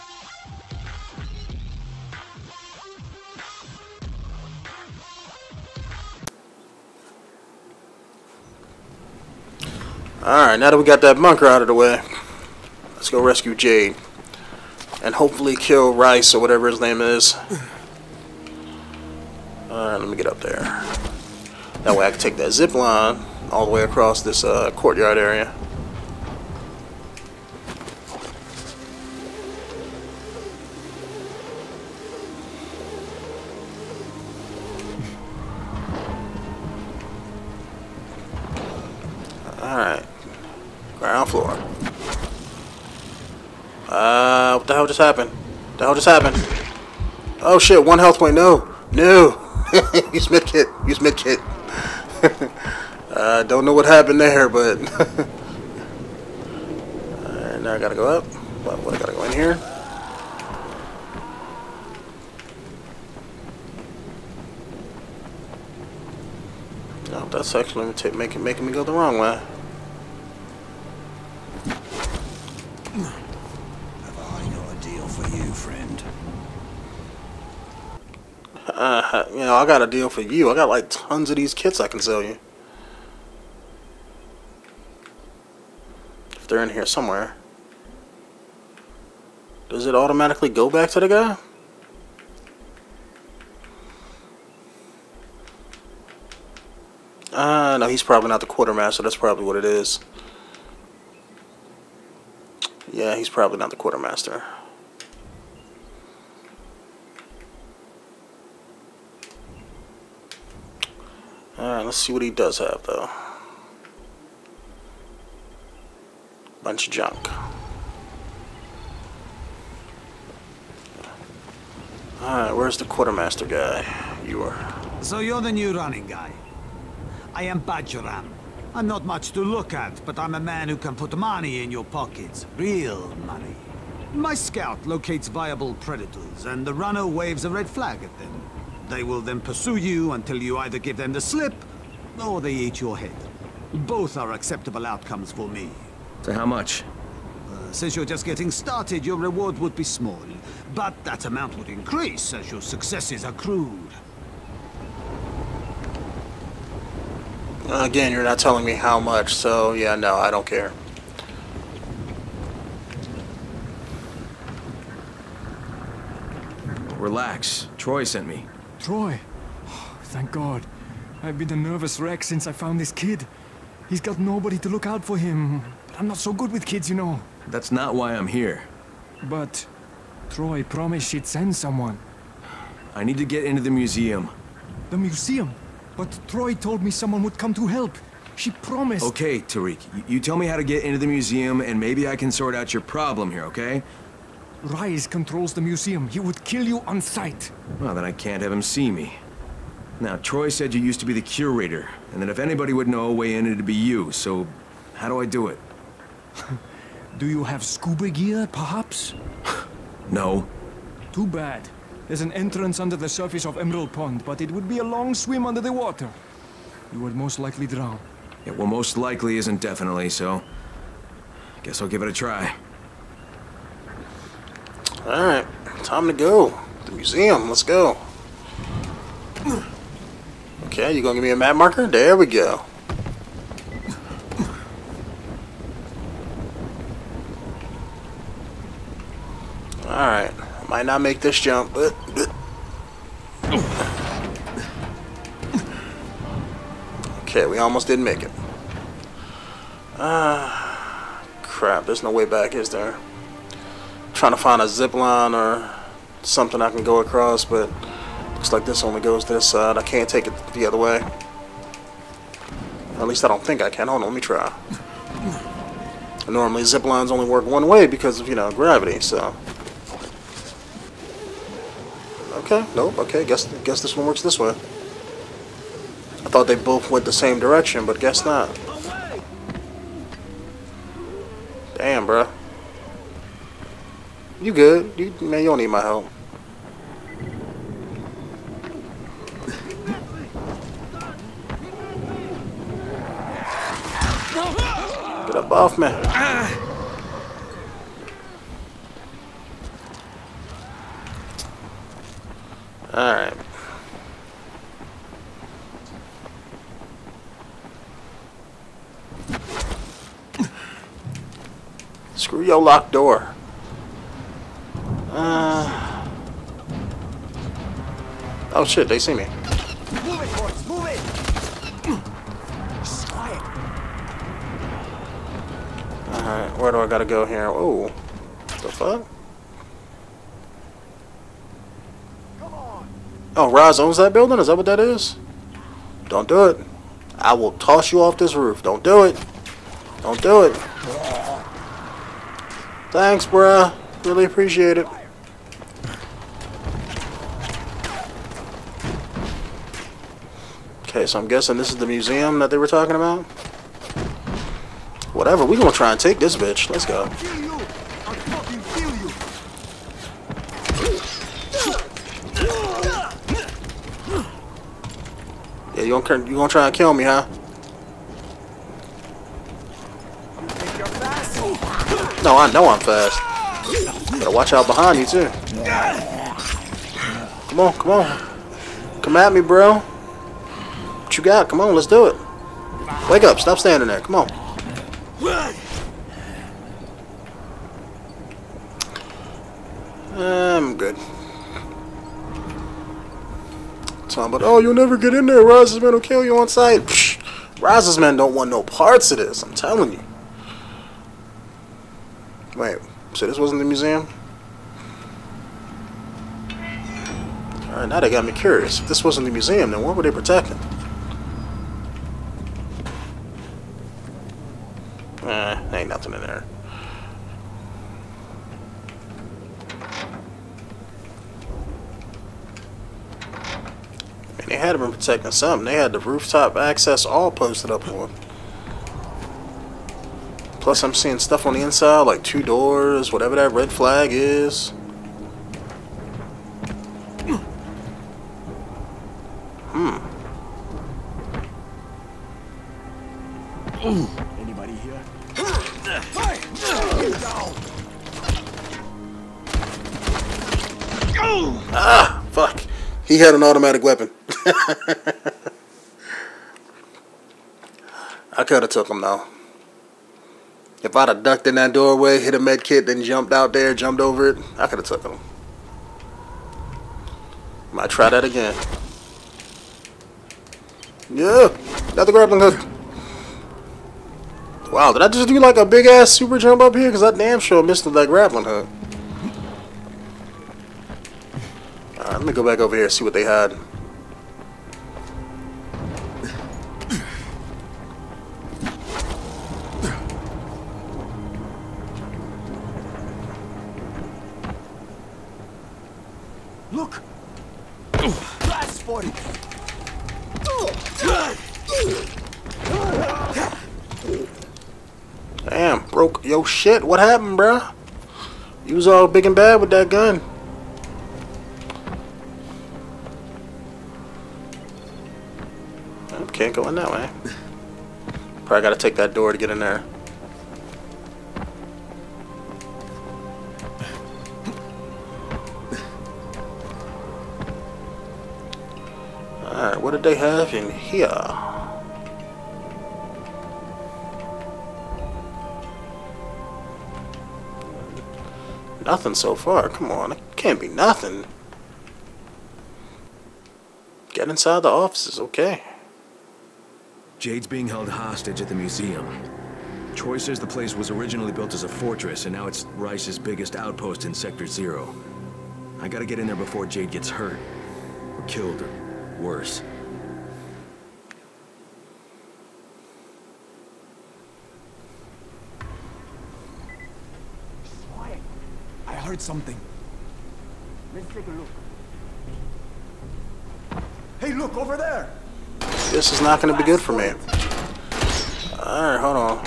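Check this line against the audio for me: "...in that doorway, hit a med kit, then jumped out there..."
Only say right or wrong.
right.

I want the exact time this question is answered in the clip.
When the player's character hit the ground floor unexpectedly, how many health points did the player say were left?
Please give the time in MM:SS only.
00:47.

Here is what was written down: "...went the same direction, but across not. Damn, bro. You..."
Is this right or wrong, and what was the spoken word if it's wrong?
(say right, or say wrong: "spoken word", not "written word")
wrong: "guess", not "across".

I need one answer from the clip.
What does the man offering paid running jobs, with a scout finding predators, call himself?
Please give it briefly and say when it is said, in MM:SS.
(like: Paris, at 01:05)
Bajoram, at 02:07.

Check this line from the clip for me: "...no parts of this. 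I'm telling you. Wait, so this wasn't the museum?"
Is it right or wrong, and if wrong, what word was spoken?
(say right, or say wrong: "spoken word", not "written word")
right.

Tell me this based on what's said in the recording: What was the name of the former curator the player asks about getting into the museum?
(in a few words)
Tariq.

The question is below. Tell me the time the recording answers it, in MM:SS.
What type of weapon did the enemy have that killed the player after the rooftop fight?
07:33.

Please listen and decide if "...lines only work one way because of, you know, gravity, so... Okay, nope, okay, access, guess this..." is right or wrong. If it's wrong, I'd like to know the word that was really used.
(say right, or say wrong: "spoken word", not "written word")
wrong: "guess", not "access".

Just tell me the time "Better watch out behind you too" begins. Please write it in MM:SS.
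06:14.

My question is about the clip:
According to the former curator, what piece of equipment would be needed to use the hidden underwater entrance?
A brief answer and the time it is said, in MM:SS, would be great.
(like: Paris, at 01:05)
Scuba gear, at 03:27.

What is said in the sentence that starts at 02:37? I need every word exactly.
Again, you're not telling me how much, so yeah, no, I don't care.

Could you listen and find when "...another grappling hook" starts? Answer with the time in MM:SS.
07:51.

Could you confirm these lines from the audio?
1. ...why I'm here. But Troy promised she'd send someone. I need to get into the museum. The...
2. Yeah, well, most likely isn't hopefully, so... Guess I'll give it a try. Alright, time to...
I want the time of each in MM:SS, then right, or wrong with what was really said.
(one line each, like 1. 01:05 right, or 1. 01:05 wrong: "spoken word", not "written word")
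1. 02:57 right
2. 03:38 wrong: "definitely", not "hopefully".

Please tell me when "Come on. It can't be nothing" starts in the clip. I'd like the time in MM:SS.
08:59.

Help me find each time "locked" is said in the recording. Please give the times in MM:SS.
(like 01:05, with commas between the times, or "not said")
05:12.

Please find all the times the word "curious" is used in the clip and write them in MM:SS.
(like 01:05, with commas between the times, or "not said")
06:48.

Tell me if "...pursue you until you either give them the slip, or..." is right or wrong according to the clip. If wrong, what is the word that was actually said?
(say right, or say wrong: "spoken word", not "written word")
right.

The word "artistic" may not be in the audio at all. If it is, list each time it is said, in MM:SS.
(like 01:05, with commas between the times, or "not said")
not said.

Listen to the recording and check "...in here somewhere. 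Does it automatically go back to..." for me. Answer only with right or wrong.
right.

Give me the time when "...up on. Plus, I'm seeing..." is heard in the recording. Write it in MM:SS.
07:07.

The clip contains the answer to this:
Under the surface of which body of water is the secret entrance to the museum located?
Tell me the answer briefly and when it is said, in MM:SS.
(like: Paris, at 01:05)
Emerald Pond, at 03:33.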